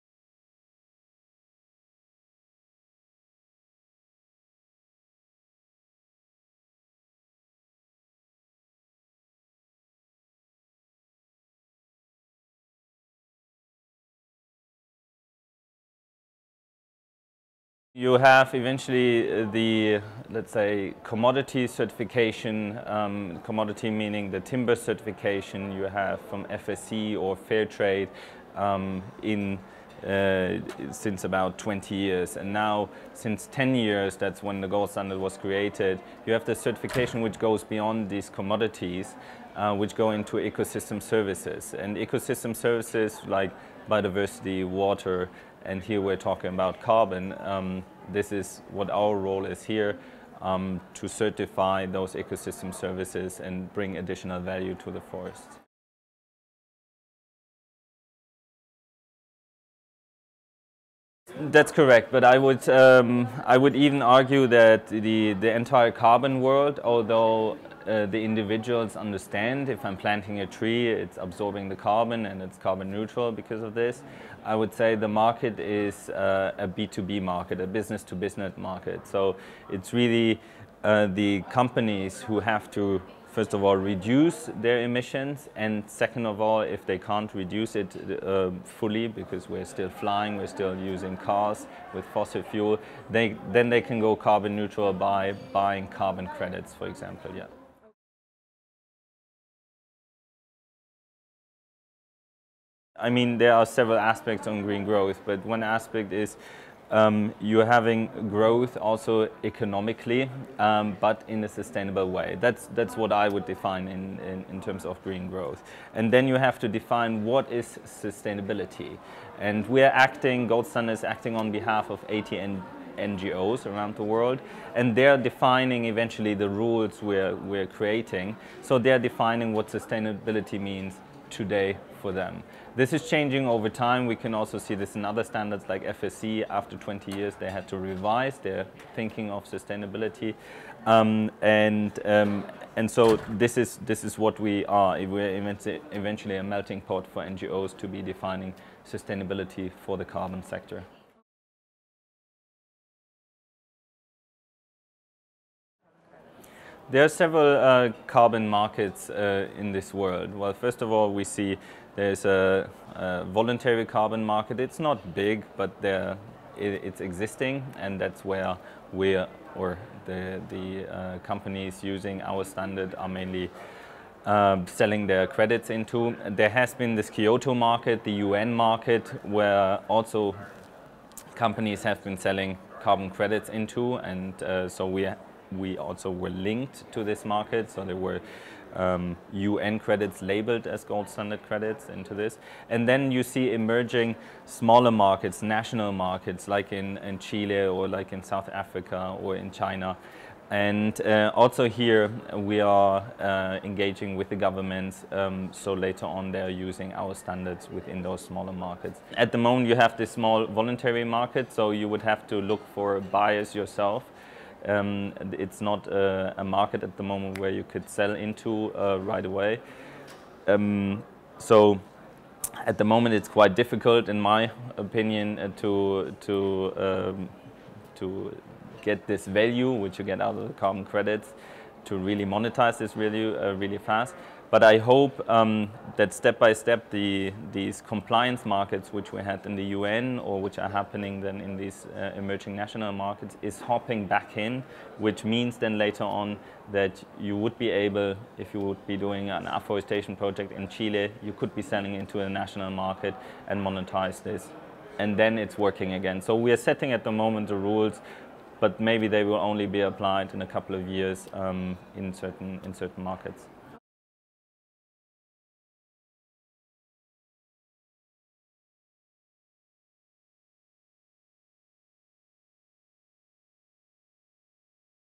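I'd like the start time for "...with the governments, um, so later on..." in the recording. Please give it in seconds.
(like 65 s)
204 s.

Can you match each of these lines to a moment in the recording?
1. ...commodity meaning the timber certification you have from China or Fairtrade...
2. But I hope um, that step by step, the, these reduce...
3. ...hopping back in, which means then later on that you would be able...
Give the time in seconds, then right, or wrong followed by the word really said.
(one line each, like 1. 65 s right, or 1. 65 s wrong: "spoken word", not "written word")
1. 23 s wrong: "FSC", not "China"
2. 234 s wrong: "compliance", not "reduce"
3. 243 s right.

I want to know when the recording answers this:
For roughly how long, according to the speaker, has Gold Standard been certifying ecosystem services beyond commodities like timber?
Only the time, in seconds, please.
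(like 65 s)
33 s.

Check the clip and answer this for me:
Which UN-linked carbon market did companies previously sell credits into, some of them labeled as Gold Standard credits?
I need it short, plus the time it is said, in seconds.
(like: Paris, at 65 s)
Kyoto market, at 177 s.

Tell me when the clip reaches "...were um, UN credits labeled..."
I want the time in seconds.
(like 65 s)
187 s.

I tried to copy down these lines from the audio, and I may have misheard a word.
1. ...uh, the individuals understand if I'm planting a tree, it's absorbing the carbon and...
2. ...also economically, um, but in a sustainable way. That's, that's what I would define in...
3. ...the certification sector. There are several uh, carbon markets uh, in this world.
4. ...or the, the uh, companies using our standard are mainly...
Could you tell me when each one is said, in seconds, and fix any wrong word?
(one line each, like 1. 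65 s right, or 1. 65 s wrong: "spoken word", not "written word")
1. 67 s right
2. 108 s right
3. 149 s wrong: "carbon", not "certification"
4. 169 s right.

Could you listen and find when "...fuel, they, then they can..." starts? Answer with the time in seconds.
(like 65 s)
92 s.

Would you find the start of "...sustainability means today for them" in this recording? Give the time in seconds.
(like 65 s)
129 s.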